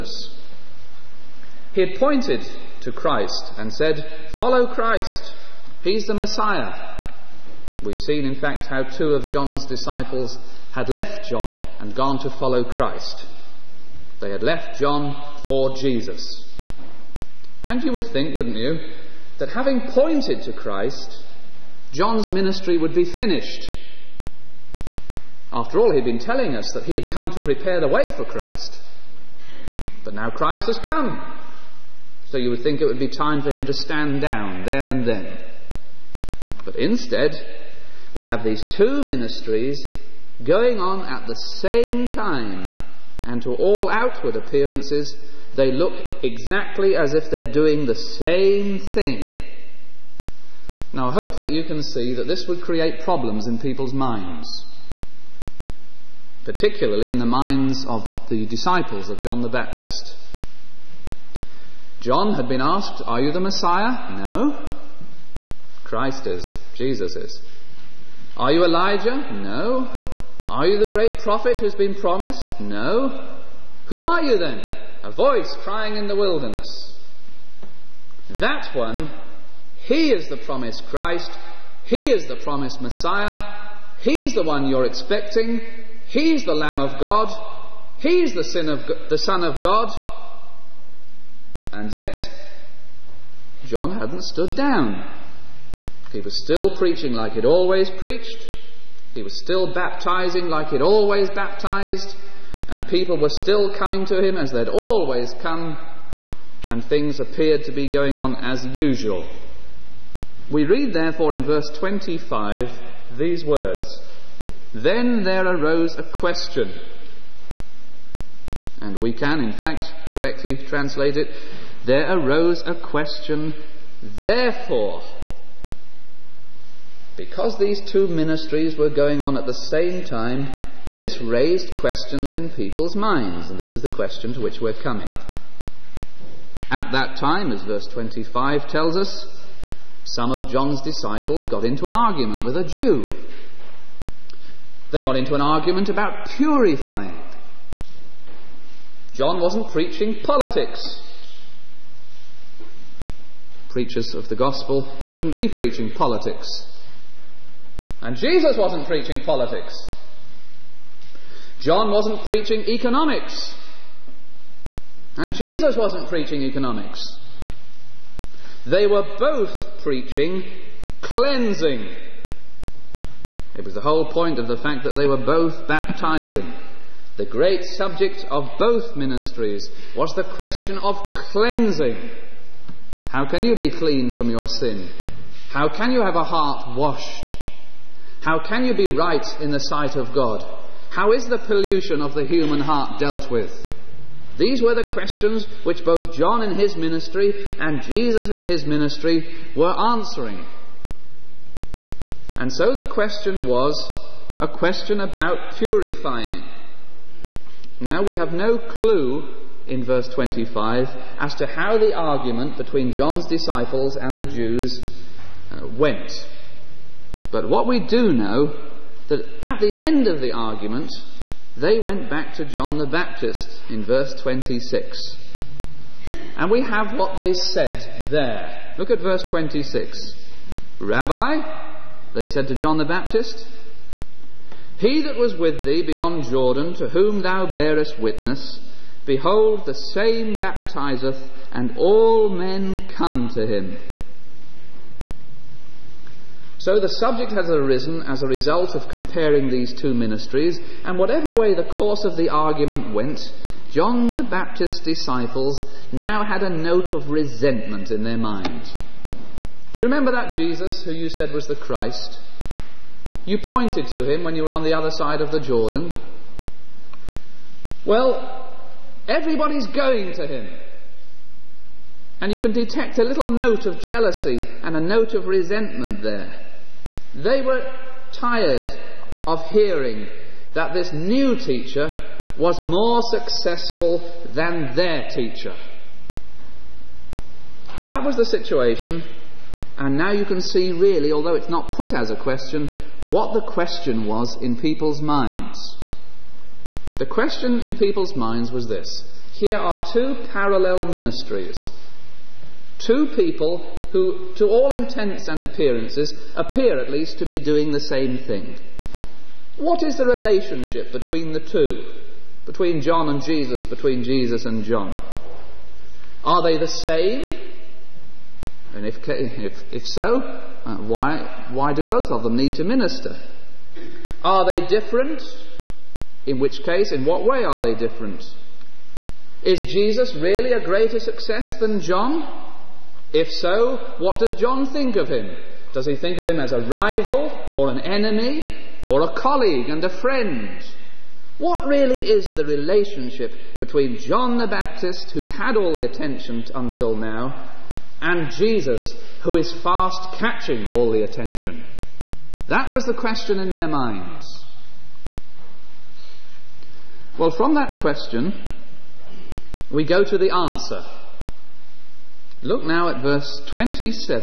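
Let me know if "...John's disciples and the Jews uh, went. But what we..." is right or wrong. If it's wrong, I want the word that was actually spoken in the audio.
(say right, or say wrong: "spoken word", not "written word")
right.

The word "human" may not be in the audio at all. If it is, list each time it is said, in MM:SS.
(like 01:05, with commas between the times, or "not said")
03:12.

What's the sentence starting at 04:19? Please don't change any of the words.
Do you remember that Jesus who you said was the Christ?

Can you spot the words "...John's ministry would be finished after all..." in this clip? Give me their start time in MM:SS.
00:21.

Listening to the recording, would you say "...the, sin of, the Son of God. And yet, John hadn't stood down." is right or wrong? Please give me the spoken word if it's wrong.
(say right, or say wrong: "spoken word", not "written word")
right.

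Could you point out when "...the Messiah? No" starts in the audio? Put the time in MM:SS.
01:03.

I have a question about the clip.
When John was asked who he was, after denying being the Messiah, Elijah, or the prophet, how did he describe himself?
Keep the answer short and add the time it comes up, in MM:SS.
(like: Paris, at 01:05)
A voice crying in the wilderness, at 01:15.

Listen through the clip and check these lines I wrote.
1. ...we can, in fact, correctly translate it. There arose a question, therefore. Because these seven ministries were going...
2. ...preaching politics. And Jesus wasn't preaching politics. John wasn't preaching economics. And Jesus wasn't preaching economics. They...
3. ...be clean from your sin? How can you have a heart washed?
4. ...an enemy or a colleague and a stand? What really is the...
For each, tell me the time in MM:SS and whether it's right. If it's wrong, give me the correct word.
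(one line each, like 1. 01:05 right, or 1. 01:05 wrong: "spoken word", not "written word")
1. 01:59 wrong: "two", not "seven"
2. 02:35 right
3. 03:03 right
4. 05:37 wrong: "friend", not "stand".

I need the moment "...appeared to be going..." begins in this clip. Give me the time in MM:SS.
01:47.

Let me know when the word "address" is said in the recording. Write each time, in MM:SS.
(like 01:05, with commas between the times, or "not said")
not said.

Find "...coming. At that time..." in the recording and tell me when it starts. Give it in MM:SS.
02:14.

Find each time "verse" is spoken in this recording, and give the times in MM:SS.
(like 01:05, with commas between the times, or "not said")
01:51, 02:17, 03:29, 03:43, 03:49, 06:03.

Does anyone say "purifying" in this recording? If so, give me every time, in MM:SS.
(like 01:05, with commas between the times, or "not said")
02:26, 03:25.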